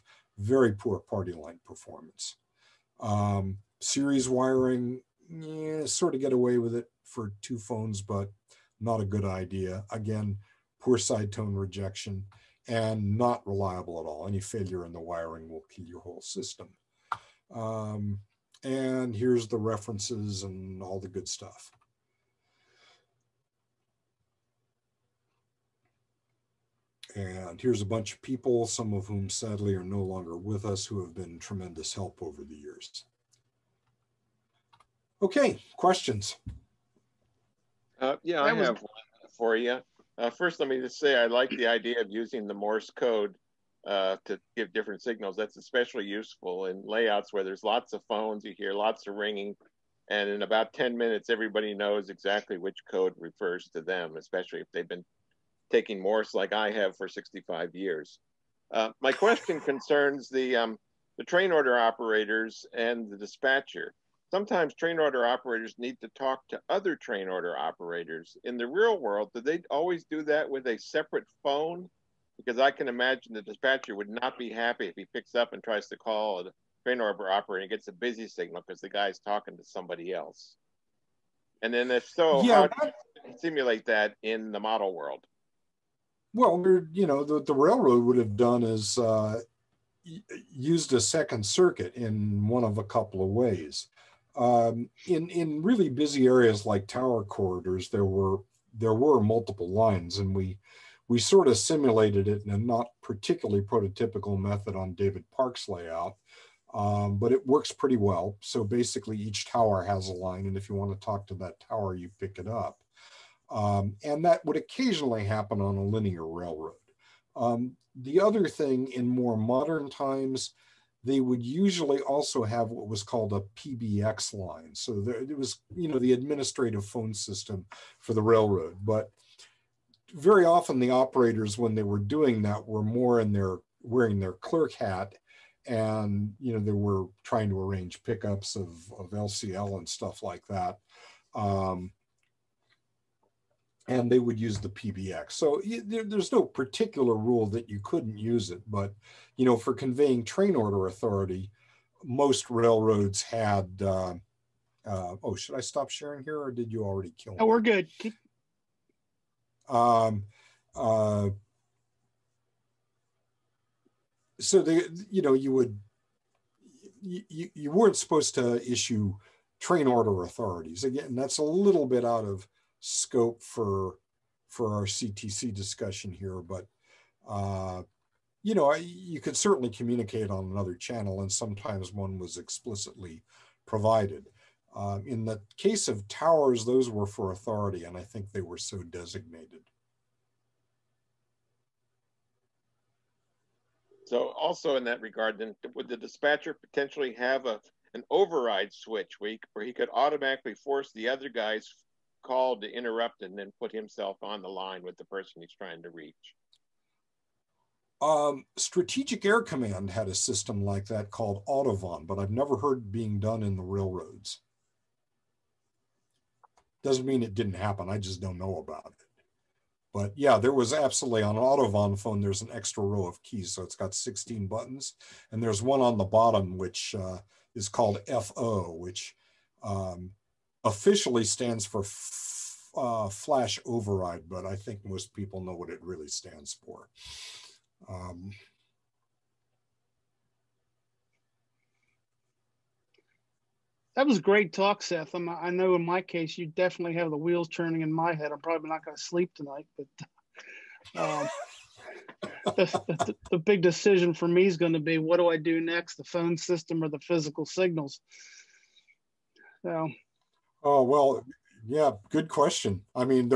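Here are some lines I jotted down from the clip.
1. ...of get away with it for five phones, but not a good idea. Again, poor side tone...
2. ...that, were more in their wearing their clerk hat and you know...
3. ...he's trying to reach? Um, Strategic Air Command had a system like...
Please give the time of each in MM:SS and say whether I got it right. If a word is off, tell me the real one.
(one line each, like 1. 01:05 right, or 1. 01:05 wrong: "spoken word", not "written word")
1. 00:06 wrong: "two", not "five"
2. 02:12 right
3. 03:25 right.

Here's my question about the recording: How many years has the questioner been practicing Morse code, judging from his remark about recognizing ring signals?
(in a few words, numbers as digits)
65 years.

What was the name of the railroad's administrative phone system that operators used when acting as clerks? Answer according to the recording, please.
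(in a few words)
PBX line.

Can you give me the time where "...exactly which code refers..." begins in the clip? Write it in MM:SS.
00:52.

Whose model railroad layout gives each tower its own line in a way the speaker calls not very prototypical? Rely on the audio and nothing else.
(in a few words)
David Park.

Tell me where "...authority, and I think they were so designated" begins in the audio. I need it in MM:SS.
03:07.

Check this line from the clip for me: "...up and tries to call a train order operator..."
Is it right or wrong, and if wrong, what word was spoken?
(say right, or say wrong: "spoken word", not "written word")
right.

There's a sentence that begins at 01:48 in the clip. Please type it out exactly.
So basically each tower has a line and if you want to talk to that tower, you pick it up.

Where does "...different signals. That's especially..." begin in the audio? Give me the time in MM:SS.
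00:44.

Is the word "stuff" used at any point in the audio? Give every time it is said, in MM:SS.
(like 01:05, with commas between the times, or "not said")
00:21, 02:19.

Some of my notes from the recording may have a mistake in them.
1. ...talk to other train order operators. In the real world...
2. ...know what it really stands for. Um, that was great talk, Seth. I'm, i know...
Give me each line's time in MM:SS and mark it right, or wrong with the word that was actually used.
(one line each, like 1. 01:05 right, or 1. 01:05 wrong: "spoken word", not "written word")
1. 01:06 right
2. 03:55 right.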